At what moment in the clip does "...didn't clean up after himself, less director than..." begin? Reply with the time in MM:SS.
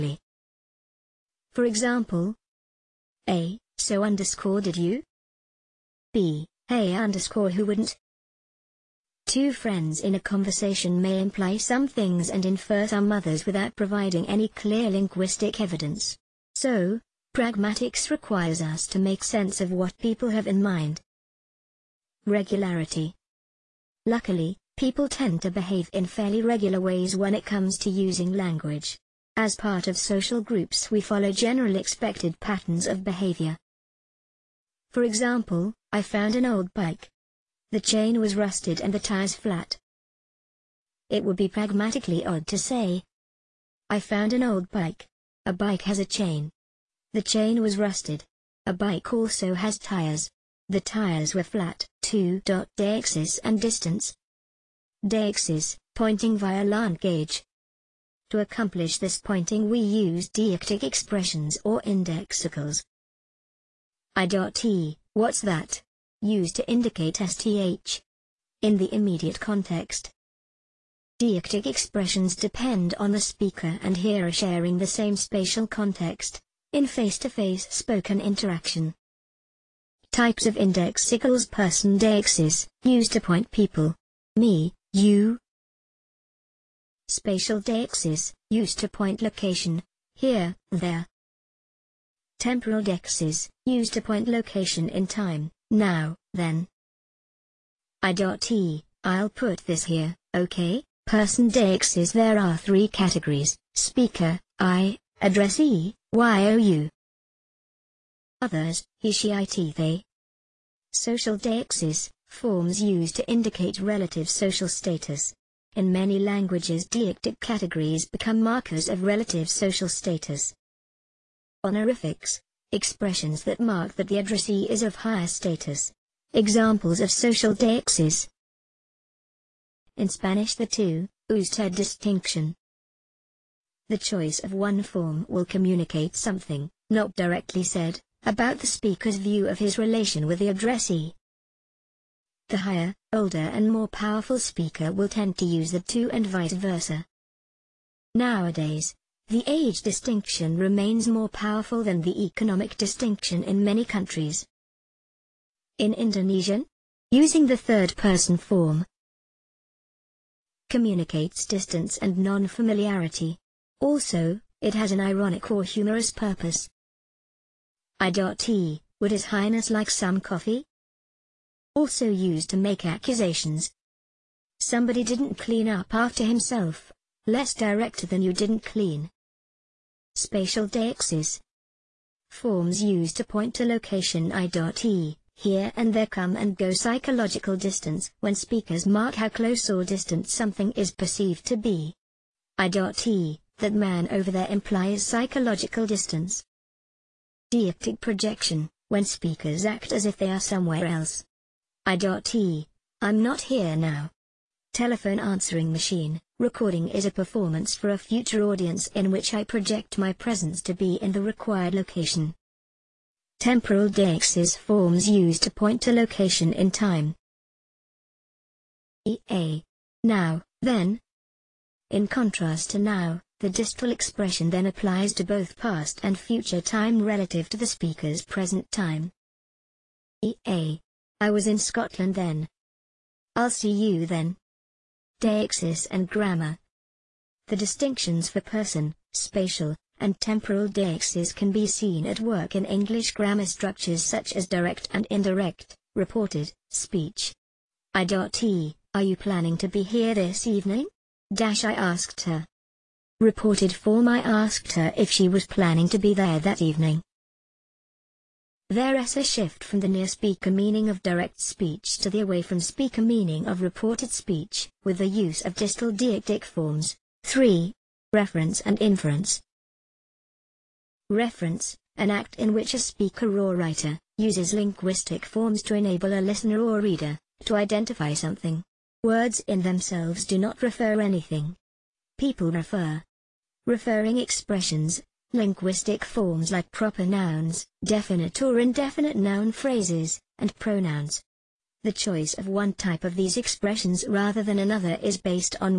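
02:55.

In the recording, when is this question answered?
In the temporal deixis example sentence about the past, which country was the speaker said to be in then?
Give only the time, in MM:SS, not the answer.
03:51.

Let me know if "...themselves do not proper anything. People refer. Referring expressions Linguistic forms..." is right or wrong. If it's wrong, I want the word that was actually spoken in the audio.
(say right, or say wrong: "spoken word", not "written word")
wrong: "refer", not "proper".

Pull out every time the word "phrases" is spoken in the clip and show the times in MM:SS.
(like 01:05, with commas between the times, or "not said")
04:49.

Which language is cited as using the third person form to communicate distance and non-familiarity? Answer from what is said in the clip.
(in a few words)
Indonesian.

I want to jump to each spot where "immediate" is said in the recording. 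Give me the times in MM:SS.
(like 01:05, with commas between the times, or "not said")
01:08.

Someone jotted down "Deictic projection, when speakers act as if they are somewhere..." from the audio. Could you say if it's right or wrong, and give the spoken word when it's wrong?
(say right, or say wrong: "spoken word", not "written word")
right.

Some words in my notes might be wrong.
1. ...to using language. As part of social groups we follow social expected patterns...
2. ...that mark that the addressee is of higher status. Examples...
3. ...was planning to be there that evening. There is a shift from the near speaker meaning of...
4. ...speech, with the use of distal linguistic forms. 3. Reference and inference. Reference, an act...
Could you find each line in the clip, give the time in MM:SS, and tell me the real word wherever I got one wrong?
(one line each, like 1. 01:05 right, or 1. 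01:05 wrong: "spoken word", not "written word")
1. 00:27 wrong: "general", not "social"
2. 02:03 right
3. 04:15 right
4. 04:24 wrong: "deictic", not "linguistic".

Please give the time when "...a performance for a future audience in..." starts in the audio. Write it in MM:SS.
03:27.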